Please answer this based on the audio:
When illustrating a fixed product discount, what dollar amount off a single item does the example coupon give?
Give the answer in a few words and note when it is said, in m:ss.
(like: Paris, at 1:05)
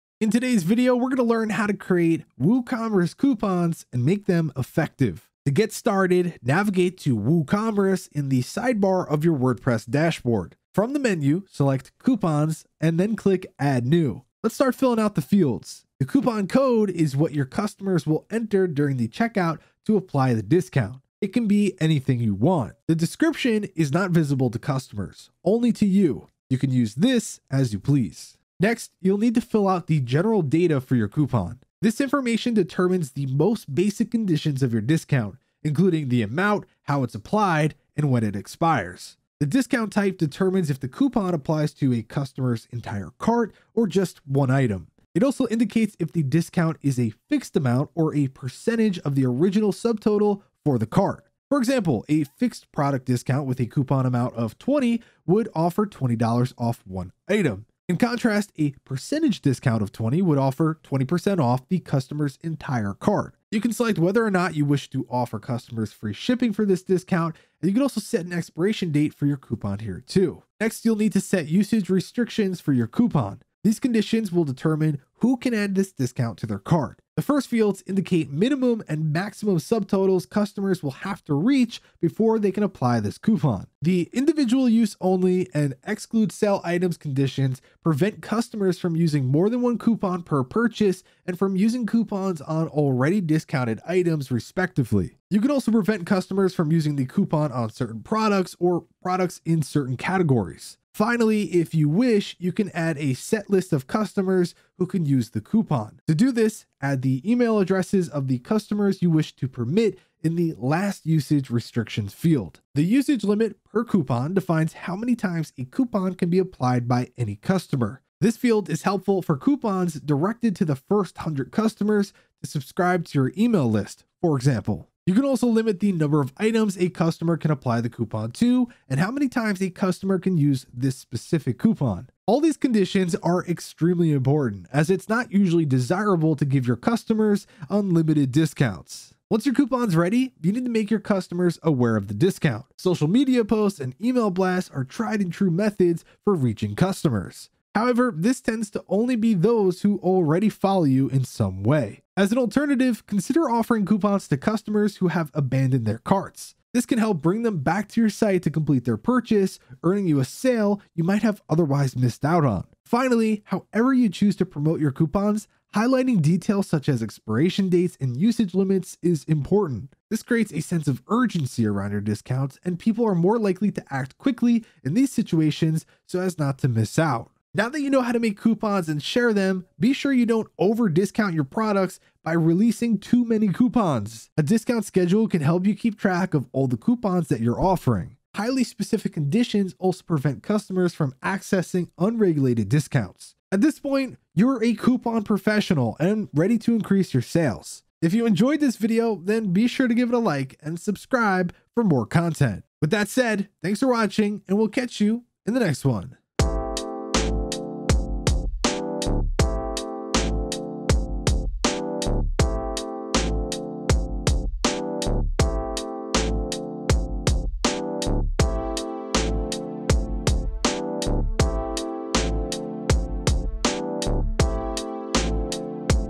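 $20, at 0:55.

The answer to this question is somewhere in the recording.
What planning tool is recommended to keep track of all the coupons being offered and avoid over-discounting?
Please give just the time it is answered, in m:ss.
3:04.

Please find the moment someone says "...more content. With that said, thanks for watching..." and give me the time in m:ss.
3:21.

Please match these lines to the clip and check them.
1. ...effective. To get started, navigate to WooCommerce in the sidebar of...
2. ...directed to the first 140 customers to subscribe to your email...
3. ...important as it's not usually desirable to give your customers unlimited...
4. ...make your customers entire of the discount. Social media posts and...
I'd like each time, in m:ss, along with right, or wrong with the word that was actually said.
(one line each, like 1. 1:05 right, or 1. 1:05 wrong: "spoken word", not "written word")
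1. 0:04 right
2. 1:59 wrong: "100", not "140"
3. 2:14 right
4. 2:20 wrong: "aware", not "entire".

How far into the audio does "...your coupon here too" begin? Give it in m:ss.
1:09.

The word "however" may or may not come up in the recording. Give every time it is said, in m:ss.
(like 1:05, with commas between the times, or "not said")
2:27, 2:43.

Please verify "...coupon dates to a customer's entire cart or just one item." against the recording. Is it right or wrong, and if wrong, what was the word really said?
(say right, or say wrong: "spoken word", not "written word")
wrong: "applies", not "dates".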